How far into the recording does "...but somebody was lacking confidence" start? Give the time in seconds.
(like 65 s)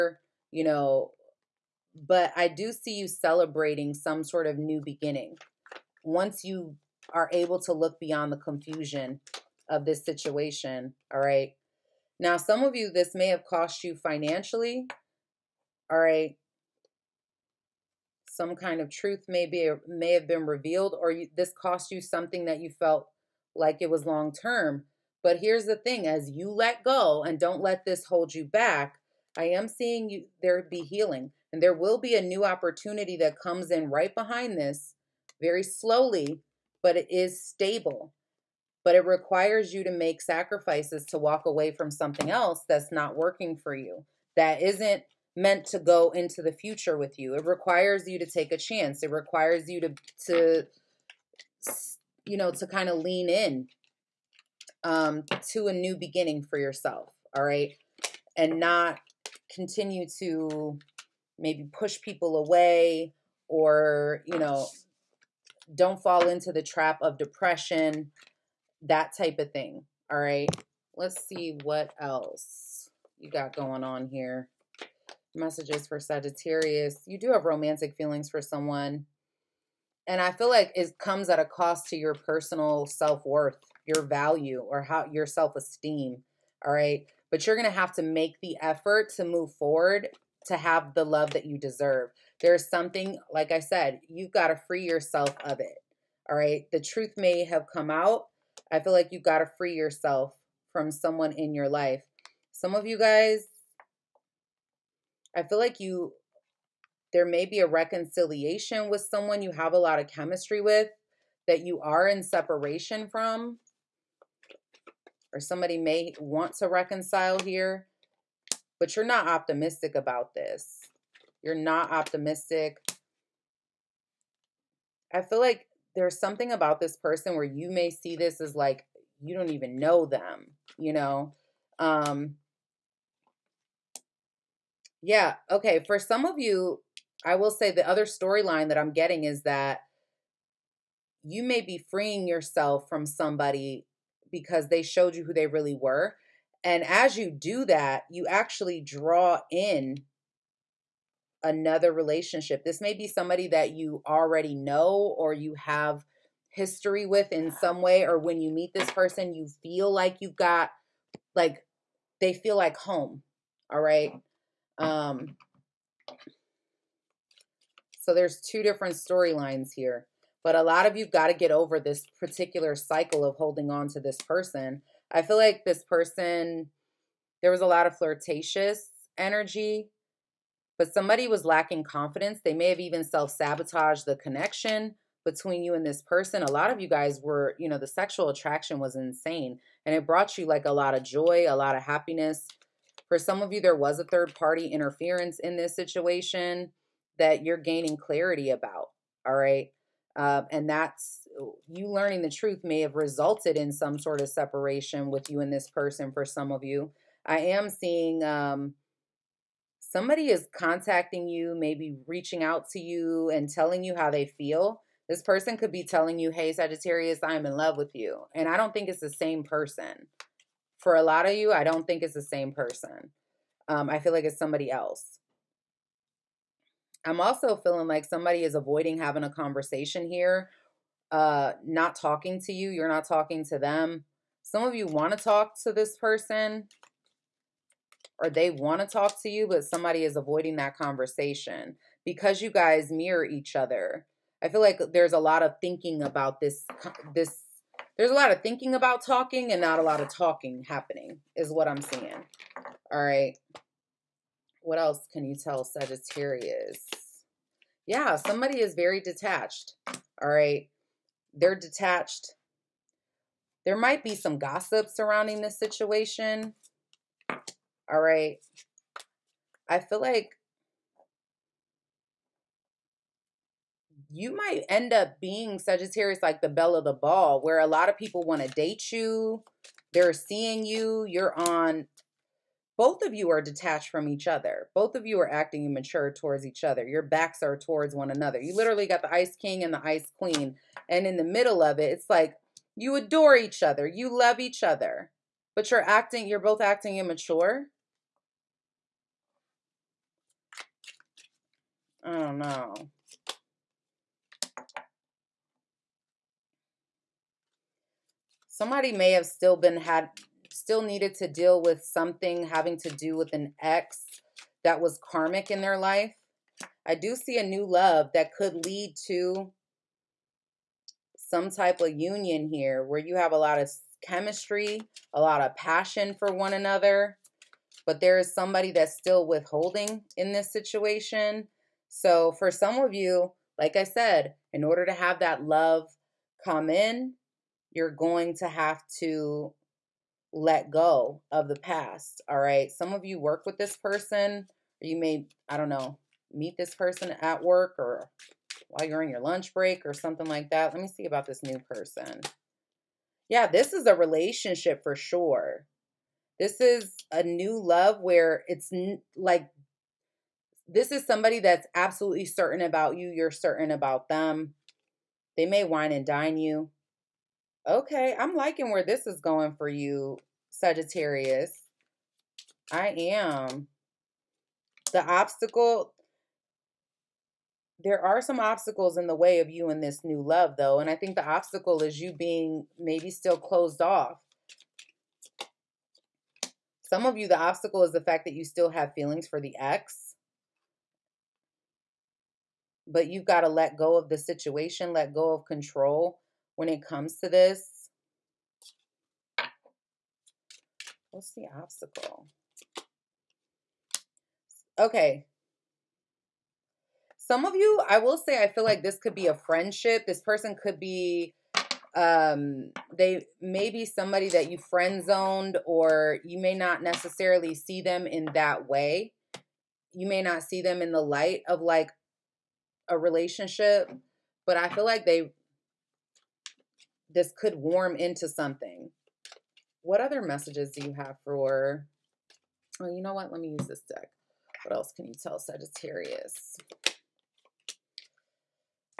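180 s.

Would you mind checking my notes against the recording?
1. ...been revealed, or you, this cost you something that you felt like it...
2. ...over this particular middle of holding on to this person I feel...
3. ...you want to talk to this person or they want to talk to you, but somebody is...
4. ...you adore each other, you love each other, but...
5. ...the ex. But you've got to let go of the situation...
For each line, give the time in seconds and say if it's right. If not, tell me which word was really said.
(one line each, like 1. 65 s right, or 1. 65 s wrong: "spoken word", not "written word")
1. 20 s right
2. 171 s wrong: "cycle", not "middle"
3. 234 s right
4. 292 s right
5. 389 s right.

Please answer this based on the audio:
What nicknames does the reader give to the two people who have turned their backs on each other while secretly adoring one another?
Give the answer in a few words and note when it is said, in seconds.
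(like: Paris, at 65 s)
The ice king and the ice queen, at 289 s.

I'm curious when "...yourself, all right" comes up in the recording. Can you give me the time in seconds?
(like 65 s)
56 s.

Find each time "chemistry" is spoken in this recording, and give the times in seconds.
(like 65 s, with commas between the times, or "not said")
110 s, 324 s.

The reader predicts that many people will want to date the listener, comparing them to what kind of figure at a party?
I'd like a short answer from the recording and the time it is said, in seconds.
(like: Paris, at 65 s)
The belle of the ball, at 276 s.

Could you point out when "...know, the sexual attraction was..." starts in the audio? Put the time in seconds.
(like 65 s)
187 s.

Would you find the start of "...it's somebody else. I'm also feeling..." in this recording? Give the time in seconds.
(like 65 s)
224 s.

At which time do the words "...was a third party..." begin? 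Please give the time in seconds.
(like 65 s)
193 s.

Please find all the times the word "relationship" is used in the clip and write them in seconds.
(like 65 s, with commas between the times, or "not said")
151 s, 353 s, 422 s.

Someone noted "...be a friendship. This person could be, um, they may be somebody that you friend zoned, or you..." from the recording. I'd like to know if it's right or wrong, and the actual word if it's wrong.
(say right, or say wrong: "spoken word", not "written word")
right.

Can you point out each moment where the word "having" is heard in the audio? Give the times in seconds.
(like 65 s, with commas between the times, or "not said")
228 s, 312 s.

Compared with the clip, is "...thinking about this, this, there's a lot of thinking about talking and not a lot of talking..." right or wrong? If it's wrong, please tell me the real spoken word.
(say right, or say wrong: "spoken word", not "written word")
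right.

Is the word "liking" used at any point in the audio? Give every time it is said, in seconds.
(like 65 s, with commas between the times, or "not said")
368 s.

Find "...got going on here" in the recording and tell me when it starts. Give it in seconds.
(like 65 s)
73 s.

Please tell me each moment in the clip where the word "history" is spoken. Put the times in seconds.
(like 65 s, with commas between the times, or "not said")
156 s.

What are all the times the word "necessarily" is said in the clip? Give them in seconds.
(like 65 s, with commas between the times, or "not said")
416 s.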